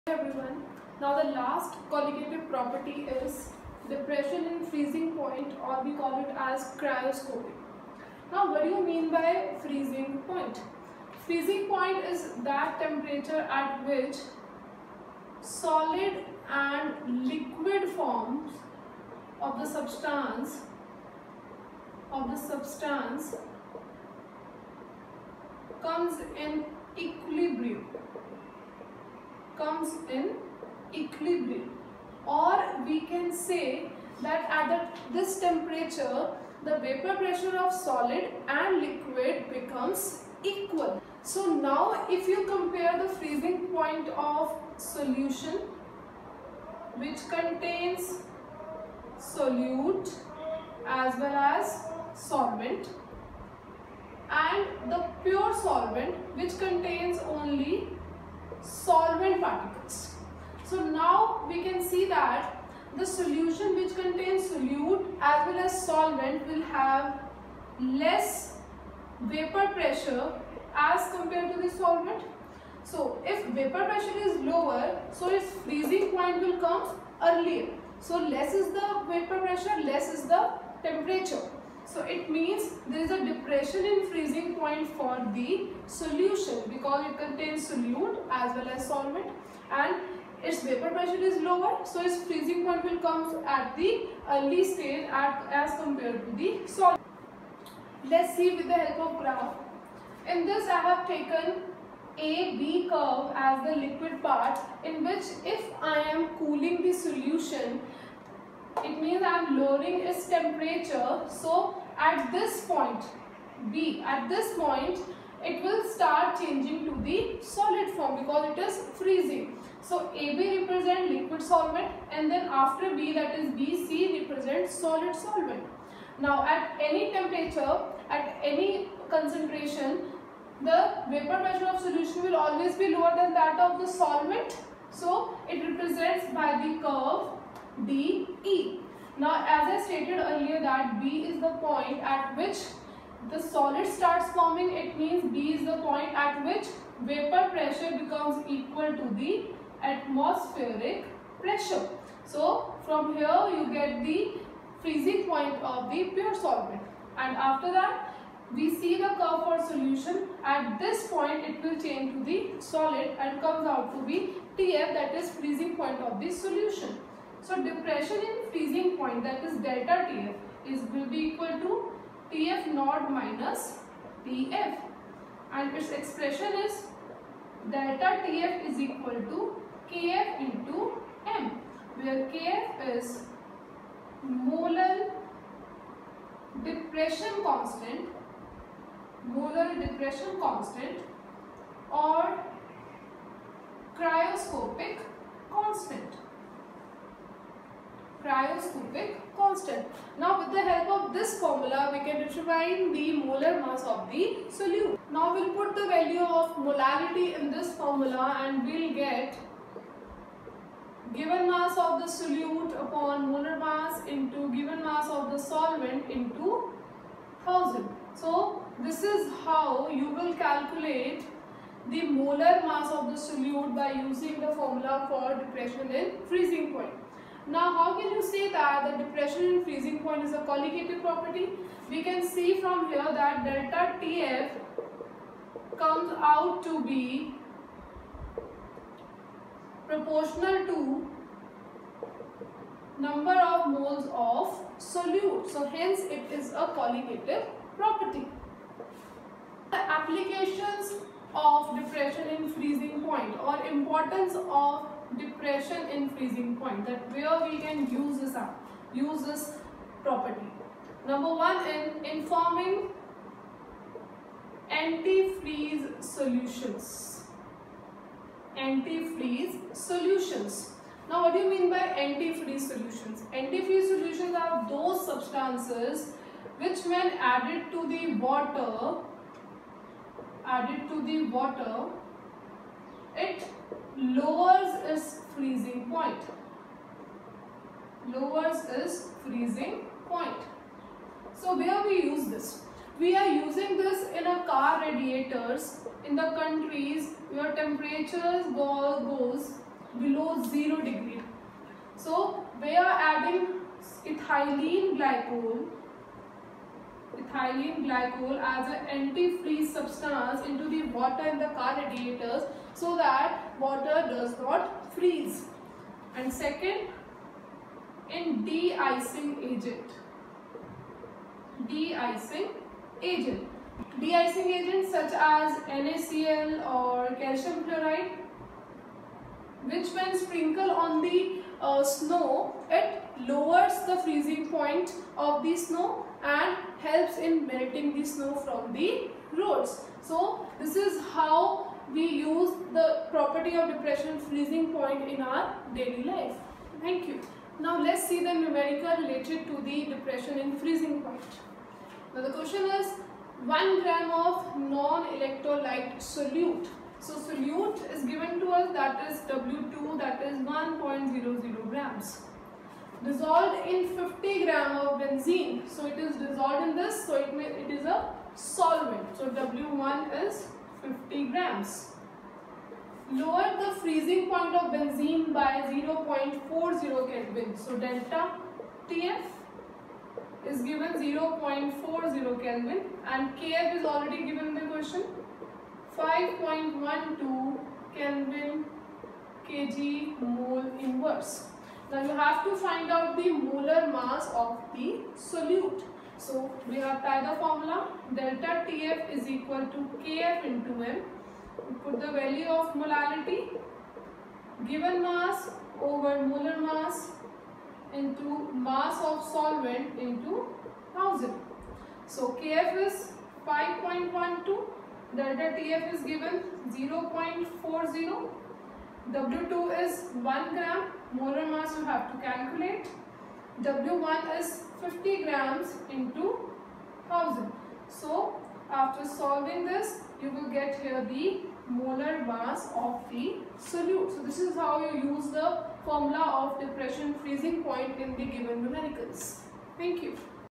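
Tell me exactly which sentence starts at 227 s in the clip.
Now how can you say that the depression in freezing point is a colligative property?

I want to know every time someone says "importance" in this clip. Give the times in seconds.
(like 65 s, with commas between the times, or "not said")
253 s.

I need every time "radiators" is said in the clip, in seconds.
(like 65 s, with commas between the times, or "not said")
294 s, 311 s.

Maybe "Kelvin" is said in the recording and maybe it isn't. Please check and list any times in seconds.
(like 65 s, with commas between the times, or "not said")
376 s, 382 s, 387 s.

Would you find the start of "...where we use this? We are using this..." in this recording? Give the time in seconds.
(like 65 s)
291 s.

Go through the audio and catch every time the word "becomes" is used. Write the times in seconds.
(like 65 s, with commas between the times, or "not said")
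39 s, 147 s.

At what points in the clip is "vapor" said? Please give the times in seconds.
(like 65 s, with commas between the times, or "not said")
36 s, 69 s, 73 s, 79 s, 90 s, 131 s, 147 s.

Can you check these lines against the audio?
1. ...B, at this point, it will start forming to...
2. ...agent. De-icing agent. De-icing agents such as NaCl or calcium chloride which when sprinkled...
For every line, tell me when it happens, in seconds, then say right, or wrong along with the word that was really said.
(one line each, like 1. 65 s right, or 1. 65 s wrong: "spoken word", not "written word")
1. 113 s wrong: "changing", not "forming"
2. 319 s right.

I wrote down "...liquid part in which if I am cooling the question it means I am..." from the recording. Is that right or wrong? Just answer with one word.
wrong.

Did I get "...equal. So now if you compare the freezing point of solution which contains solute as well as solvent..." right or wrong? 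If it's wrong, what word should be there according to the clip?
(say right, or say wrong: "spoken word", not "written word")
right.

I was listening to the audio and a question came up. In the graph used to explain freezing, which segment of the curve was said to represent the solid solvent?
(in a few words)
BC.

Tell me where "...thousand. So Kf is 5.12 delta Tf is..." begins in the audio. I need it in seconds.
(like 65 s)
410 s.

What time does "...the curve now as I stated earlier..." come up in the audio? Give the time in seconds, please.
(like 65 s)
136 s.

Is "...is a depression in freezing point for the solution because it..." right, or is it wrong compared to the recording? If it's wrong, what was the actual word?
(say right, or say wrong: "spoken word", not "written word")
right.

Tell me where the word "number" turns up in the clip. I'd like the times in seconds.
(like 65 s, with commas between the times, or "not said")
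242 s, 261 s.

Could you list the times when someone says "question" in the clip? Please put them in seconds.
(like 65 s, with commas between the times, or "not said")
352 s, 384 s.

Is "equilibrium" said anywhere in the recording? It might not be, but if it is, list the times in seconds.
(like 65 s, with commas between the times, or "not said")
26 s, 31 s.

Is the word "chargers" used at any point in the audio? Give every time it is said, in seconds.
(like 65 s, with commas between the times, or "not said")
not said.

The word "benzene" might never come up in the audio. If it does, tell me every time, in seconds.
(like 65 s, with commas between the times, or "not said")
365 s, 374 s.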